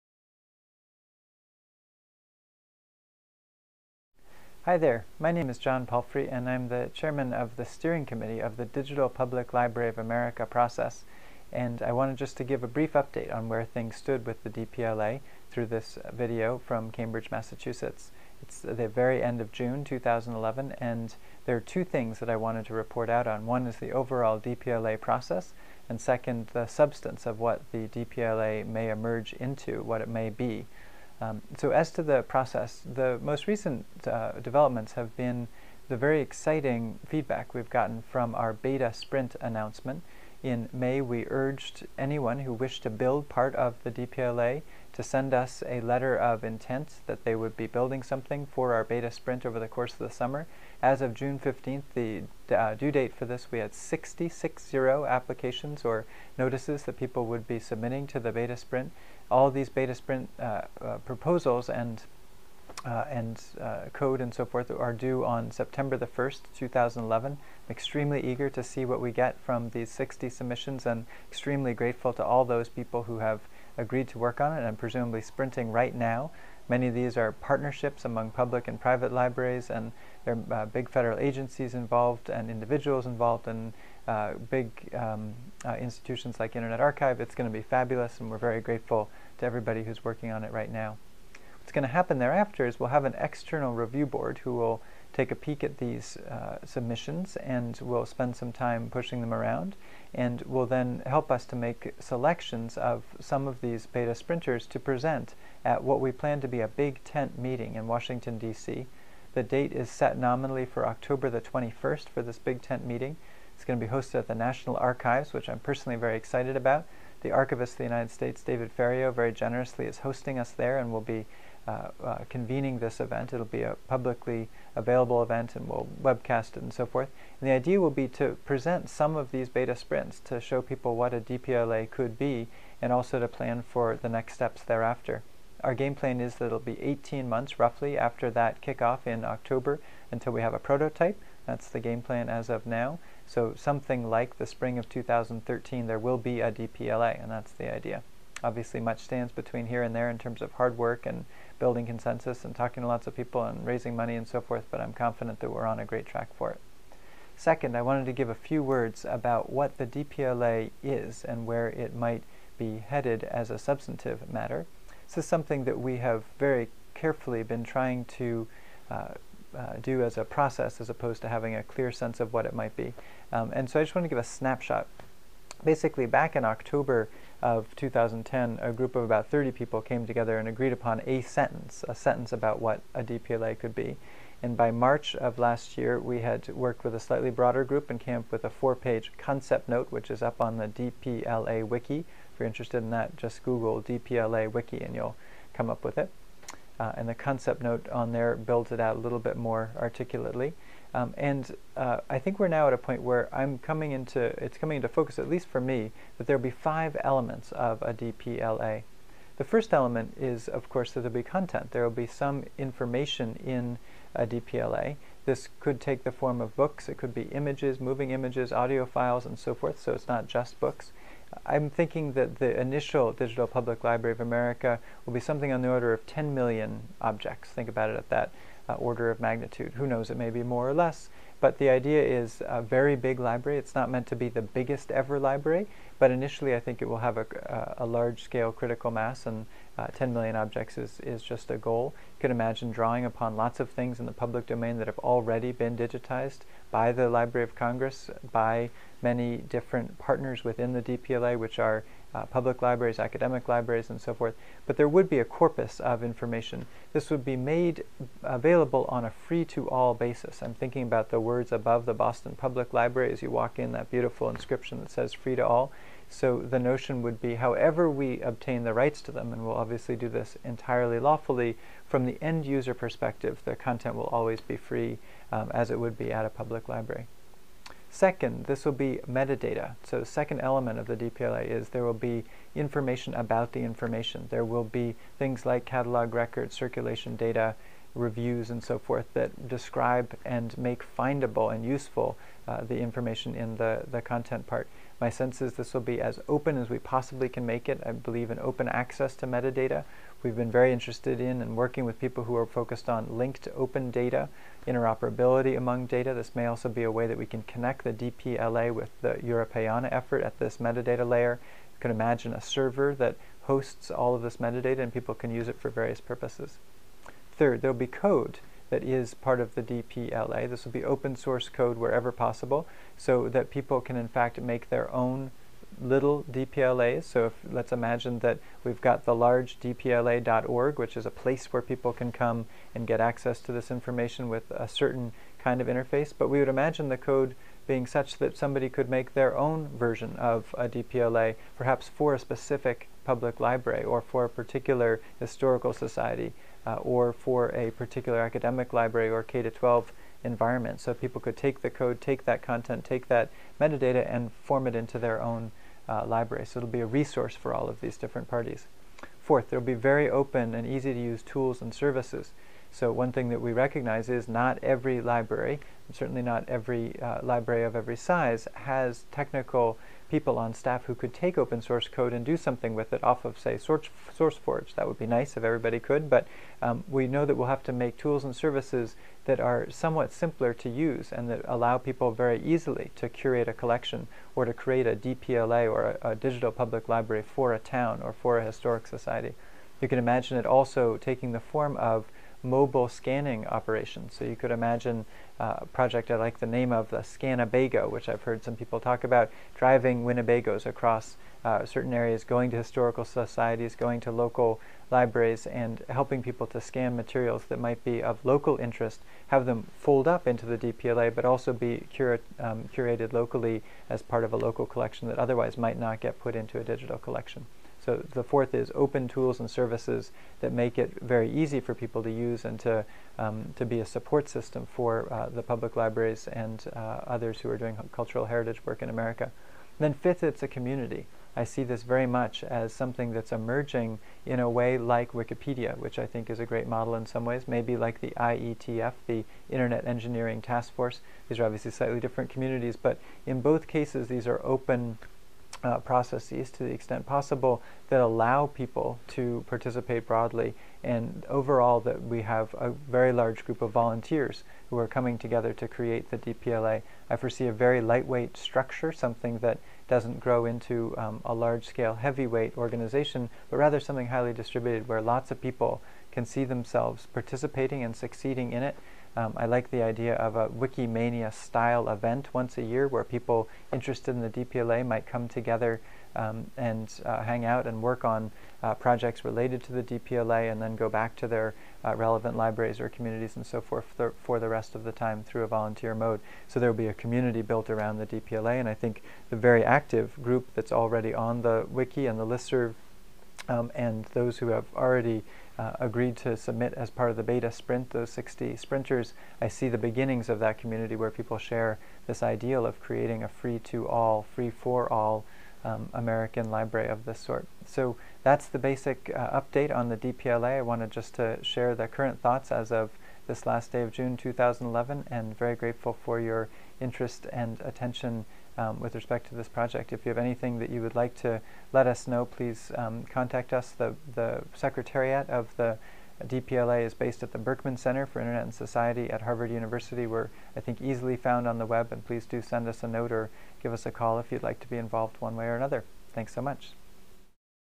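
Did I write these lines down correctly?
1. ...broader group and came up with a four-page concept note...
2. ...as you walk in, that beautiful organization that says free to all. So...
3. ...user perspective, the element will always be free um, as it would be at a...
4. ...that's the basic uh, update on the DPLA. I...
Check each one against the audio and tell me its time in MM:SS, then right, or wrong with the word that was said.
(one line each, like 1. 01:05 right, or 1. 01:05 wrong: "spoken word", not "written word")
1. 03:07 right
2. 04:23 wrong: "inscription", not "organization"
3. 04:32 wrong: "content", not "element"
4. 08:28 right.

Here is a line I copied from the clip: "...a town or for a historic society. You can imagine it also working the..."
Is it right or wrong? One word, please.
wrong.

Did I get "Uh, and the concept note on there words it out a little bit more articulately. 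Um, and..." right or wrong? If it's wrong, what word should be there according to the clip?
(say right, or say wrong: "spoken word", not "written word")
wrong: "builds", not "words".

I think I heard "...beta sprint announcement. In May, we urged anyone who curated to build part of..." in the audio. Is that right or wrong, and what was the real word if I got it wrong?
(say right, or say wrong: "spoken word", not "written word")
wrong: "wished", not "curated".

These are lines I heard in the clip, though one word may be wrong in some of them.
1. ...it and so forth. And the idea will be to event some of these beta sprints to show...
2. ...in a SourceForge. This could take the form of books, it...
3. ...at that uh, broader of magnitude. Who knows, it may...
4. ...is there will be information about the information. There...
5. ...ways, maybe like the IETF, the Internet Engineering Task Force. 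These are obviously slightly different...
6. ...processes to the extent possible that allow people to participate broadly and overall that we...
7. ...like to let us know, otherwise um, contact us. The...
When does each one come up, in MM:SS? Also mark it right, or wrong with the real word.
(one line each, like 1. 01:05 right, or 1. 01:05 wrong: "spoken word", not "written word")
1. 02:06 wrong: "present", not "event"
2. 03:33 wrong: "DPLA", not "SourceForge"
3. 03:47 wrong: "order", not "broader"
4. 04:41 right
5. 07:17 right
6. 07:25 right
7. 08:40 wrong: "please", not "otherwise".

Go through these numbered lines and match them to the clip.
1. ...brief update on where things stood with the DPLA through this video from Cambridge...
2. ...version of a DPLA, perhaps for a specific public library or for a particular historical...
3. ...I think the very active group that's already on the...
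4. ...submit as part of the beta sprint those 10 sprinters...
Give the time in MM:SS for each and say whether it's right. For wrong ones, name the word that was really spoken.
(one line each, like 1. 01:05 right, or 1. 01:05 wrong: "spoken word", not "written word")
1. 00:12 right
2. 05:39 right
3. 08:08 right
4. 08:16 wrong: "60", not "10".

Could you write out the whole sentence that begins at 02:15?
Our game plan is that it'll be 18 months roughly after that kickoff in October until we have a prototype.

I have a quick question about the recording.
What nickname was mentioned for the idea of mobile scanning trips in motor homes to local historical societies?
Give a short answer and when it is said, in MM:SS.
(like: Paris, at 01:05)
Scanabago, at 06:36.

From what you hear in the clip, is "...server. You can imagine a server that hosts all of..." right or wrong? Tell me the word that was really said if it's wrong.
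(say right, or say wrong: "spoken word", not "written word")
wrong: "layer", not "server".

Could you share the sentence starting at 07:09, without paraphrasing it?
And then fifth, it's a community.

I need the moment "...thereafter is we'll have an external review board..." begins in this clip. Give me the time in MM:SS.
01:32.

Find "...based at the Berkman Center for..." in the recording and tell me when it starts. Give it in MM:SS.
08:46.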